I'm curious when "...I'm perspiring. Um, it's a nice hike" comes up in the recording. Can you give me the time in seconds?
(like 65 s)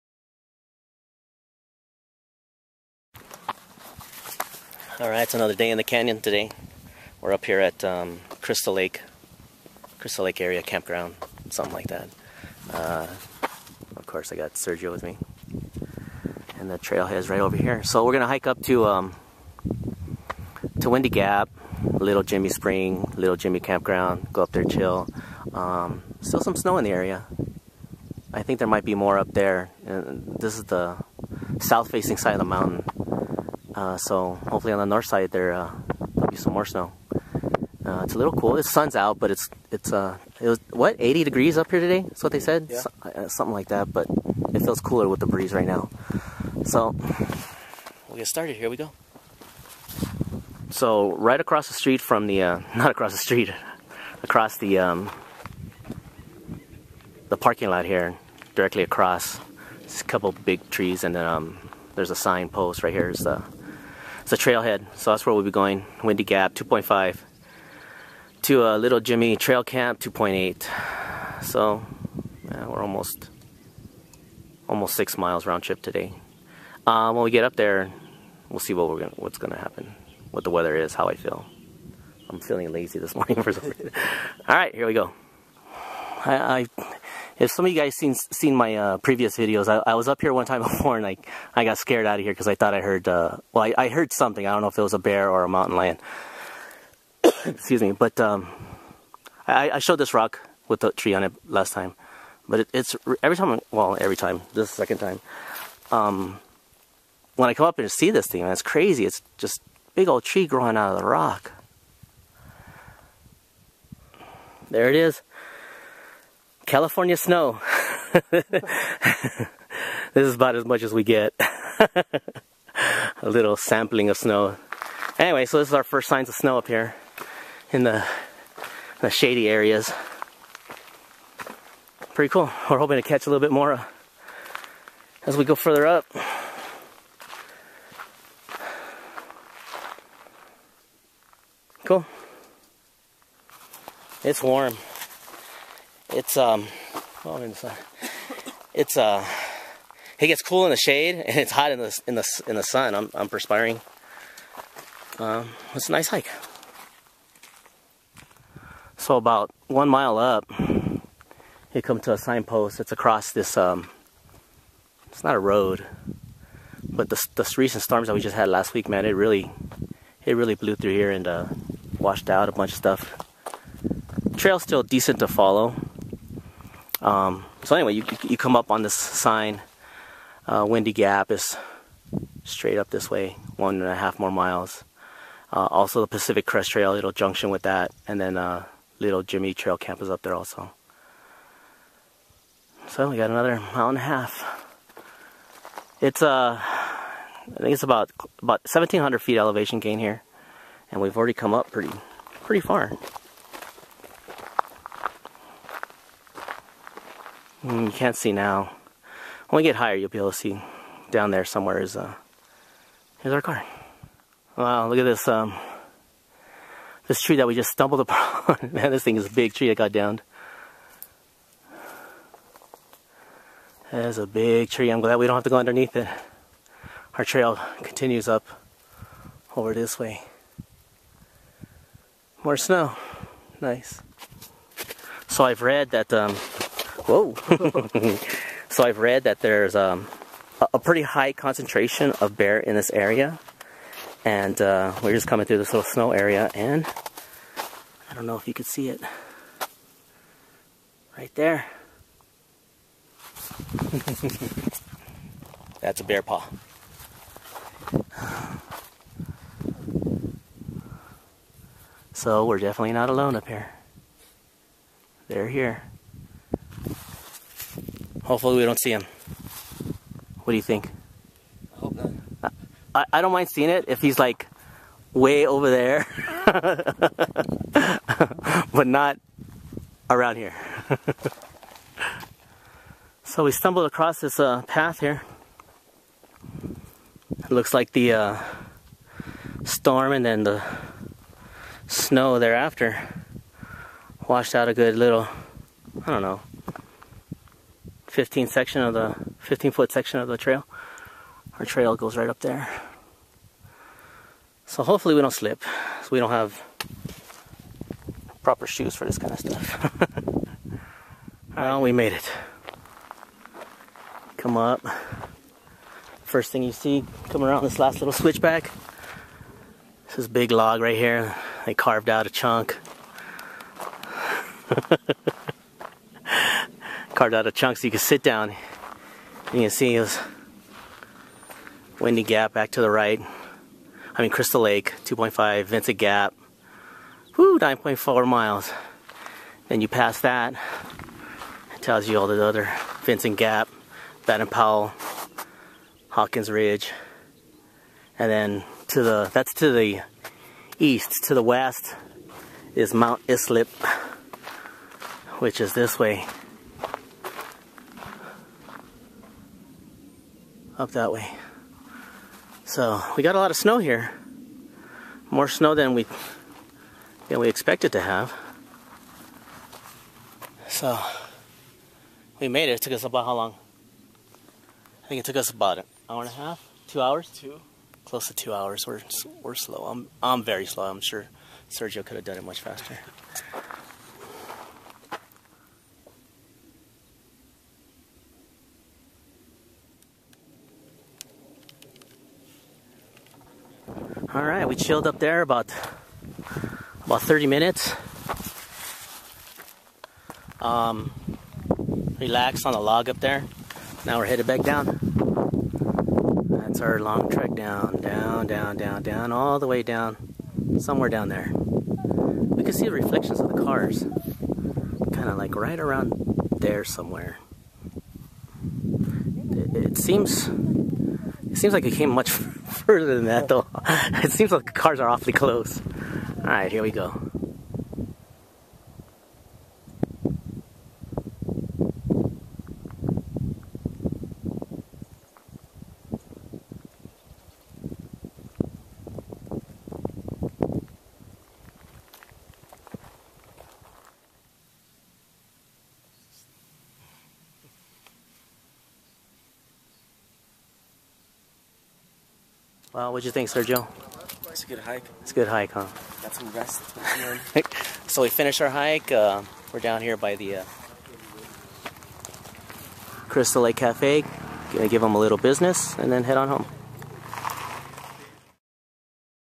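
153 s.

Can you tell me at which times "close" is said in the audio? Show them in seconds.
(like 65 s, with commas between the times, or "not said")
378 s, 425 s.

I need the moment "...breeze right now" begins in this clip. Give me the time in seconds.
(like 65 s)
45 s.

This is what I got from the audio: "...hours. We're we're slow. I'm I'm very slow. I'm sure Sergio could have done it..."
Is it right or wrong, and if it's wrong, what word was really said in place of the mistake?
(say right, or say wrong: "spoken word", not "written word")
right.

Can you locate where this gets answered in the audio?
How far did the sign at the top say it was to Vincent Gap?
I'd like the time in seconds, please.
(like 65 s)
337 s.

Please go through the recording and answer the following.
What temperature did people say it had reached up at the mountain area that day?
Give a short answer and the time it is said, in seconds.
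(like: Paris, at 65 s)
80 degrees, at 40 s.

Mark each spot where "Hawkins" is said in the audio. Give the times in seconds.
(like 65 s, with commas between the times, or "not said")
346 s.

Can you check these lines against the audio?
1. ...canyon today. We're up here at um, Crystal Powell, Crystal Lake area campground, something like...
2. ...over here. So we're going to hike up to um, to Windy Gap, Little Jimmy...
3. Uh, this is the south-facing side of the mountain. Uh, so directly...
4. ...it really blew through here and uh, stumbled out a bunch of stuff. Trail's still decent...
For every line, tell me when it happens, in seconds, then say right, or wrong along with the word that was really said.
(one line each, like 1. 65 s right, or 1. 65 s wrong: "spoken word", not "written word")
1. 5 s wrong: "Lake", not "Powell"
2. 17 s right
3. 29 s wrong: "hopefully", not "directly"
4. 170 s wrong: "washed", not "stumbled".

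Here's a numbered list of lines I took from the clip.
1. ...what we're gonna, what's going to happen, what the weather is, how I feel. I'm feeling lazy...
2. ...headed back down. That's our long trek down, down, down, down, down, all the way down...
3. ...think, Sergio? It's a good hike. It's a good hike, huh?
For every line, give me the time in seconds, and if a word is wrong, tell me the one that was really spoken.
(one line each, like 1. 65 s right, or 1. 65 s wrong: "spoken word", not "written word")
1. 78 s right
2. 404 s right
3. 453 s right.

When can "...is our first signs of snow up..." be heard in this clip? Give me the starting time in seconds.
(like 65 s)
125 s.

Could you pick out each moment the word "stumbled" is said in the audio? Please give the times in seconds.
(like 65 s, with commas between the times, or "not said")
217 s, 283 s.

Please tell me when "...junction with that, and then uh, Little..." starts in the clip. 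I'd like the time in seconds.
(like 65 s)
187 s.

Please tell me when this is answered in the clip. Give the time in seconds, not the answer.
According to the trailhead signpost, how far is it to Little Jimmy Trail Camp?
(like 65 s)
68 s.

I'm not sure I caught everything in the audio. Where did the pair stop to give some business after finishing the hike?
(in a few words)
Crystal Lake Cafe.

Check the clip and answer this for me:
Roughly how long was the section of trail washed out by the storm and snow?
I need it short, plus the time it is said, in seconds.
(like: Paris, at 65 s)
15 feet, at 299 s.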